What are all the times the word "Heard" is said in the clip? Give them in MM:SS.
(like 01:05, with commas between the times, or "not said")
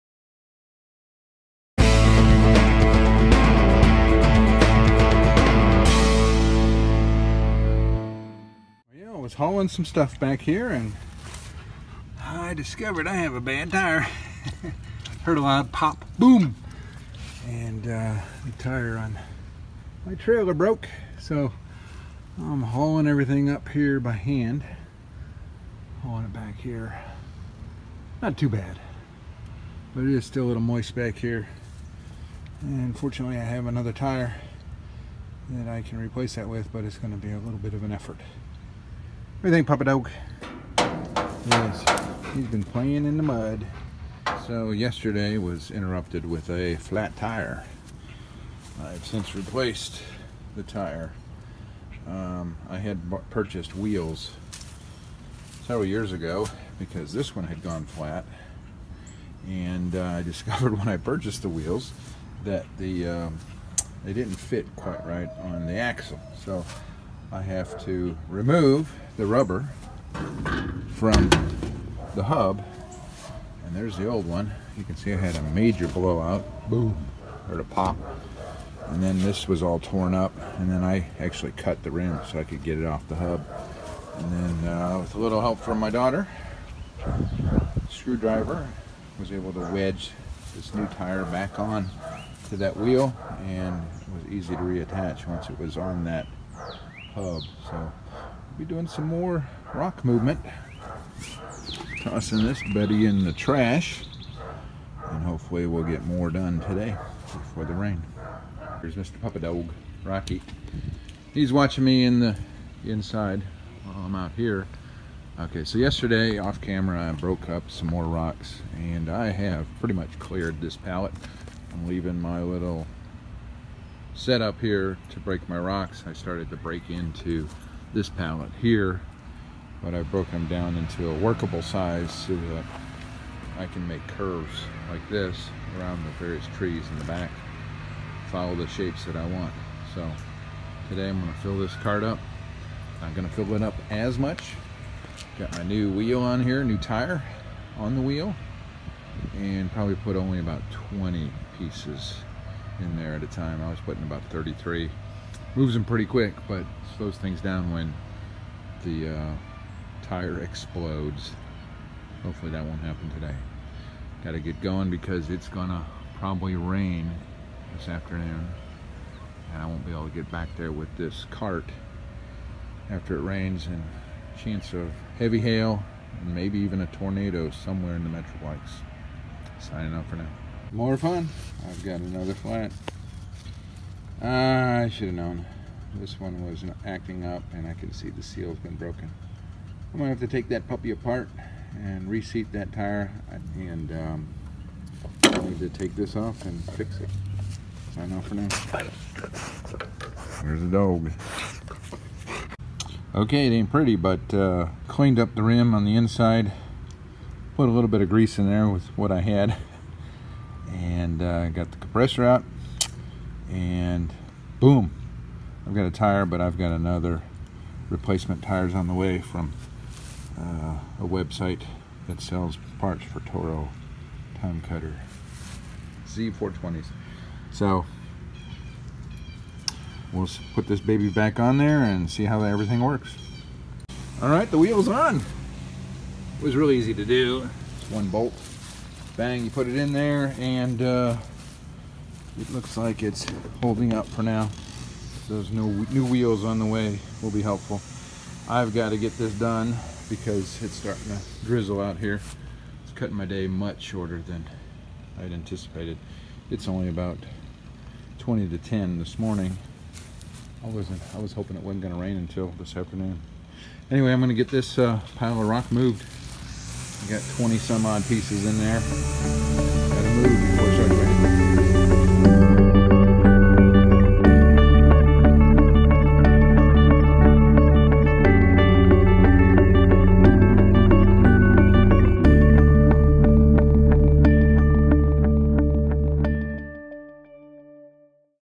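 00:15, 01:17.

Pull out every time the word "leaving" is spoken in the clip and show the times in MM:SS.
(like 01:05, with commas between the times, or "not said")
02:01.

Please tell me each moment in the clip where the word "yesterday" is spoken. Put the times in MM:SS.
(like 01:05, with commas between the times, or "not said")
00:44, 01:55.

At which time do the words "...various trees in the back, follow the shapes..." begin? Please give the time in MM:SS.
02:16.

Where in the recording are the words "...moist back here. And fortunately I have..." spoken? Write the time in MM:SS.
00:30.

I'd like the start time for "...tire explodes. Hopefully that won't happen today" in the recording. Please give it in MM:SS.
02:40.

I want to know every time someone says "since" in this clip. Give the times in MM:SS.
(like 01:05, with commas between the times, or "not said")
00:49.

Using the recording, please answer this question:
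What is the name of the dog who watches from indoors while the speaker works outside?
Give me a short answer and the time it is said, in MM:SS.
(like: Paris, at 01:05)
Rocky, at 01:50.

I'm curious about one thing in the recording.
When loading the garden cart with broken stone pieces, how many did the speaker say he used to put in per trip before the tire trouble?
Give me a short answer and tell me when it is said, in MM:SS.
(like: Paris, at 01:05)
33, at 02:34.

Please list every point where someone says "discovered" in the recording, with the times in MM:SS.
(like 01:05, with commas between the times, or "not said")
00:12, 01:00.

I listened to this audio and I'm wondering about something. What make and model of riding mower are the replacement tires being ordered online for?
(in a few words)
Toro TimeCutter Z420.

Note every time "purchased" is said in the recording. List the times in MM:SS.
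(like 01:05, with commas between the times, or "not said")
00:53, 01:00.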